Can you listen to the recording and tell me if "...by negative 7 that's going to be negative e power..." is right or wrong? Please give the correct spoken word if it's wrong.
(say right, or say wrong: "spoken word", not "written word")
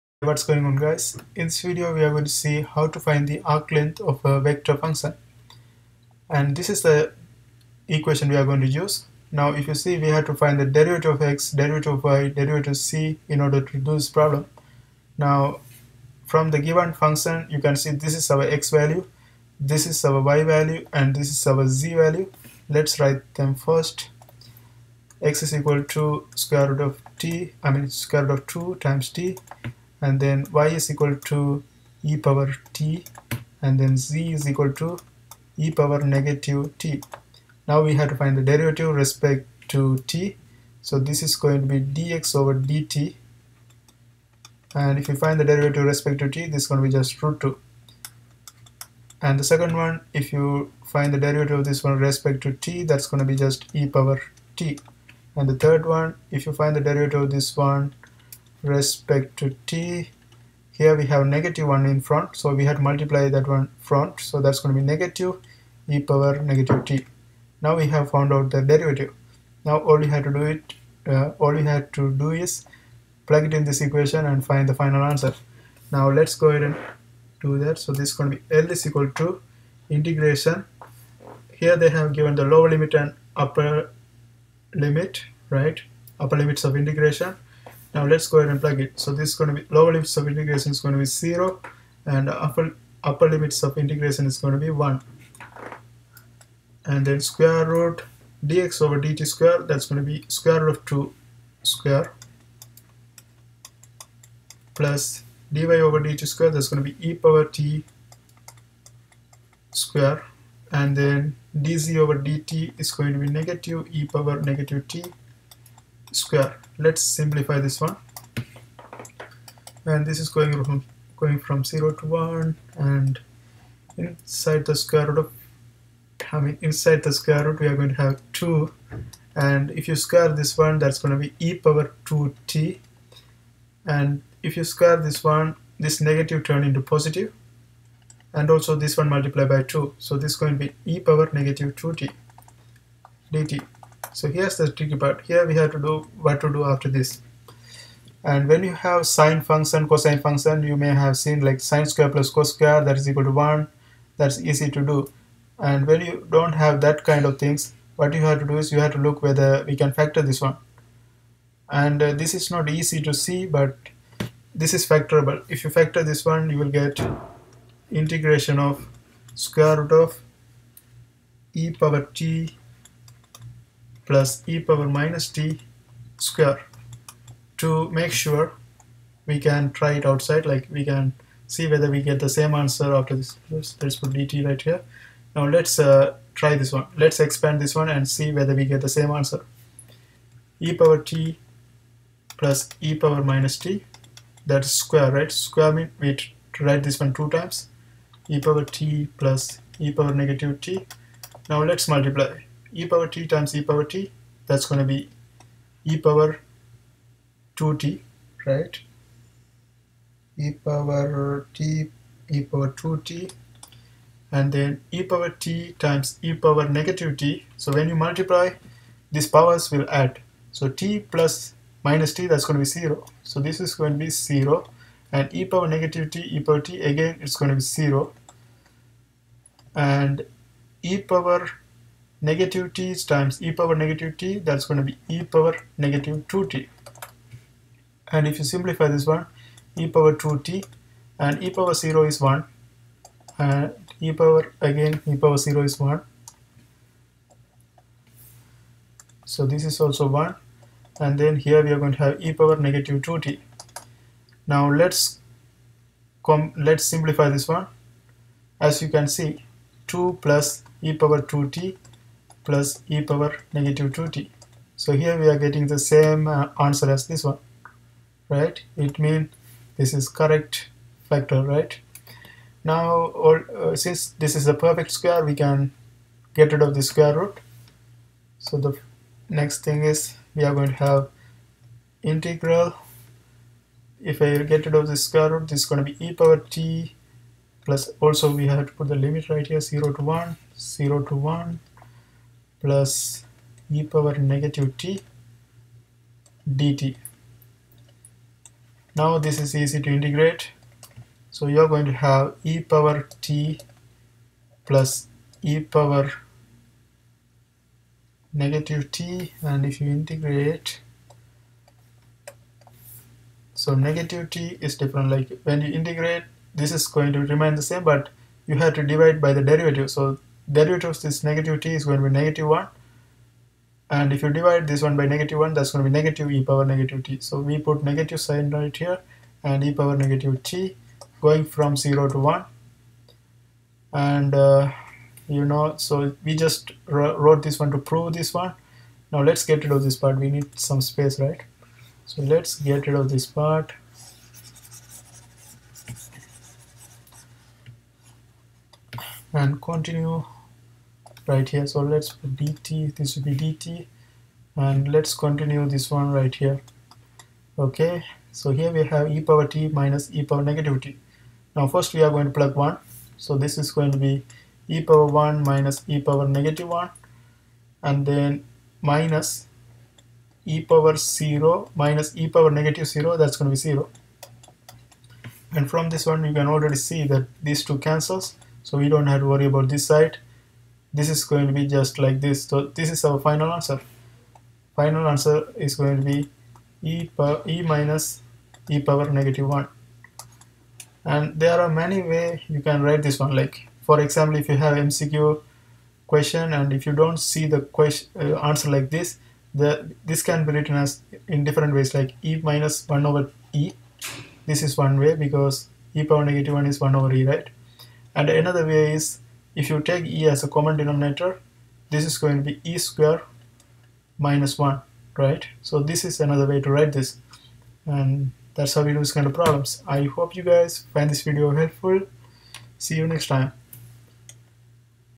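wrong: "1", not "7".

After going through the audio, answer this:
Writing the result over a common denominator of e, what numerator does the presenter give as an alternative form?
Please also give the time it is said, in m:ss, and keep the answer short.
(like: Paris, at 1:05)
e^2 - 1, at 6:52.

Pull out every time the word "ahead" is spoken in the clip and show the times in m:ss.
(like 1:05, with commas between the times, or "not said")
1:16, 1:28.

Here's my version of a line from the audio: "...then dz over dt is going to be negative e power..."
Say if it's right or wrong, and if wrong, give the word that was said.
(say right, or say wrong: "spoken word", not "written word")
right.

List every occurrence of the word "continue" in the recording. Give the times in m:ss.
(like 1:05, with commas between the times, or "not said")
5:49, 5:55.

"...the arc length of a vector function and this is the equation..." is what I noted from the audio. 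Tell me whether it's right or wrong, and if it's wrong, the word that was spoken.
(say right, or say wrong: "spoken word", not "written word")
right.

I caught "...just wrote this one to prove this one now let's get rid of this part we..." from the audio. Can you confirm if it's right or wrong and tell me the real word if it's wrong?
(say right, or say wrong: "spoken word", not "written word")
right.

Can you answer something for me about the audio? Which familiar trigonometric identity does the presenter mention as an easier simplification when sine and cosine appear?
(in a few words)
sin^2 + cos^2 = 1.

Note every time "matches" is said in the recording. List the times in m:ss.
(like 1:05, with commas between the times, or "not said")
not said.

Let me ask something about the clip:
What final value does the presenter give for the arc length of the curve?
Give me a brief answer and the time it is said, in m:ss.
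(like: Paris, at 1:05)
e - e^(-1), at 6:27.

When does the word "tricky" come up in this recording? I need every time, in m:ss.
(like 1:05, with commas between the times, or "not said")
2:24.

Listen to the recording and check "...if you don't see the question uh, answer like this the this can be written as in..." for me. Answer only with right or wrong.
right.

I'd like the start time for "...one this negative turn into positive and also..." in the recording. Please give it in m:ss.
2:15.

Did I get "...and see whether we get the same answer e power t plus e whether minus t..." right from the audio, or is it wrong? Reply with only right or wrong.
wrong.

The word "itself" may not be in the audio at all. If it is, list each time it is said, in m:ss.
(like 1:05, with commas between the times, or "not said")
not said.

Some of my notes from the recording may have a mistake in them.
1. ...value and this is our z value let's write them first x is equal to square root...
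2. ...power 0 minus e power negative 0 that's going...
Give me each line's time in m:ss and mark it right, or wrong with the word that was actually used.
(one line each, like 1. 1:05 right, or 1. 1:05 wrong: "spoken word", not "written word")
1. 0:20 right
2. 6:10 right.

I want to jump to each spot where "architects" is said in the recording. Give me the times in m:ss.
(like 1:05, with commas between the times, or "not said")
not said.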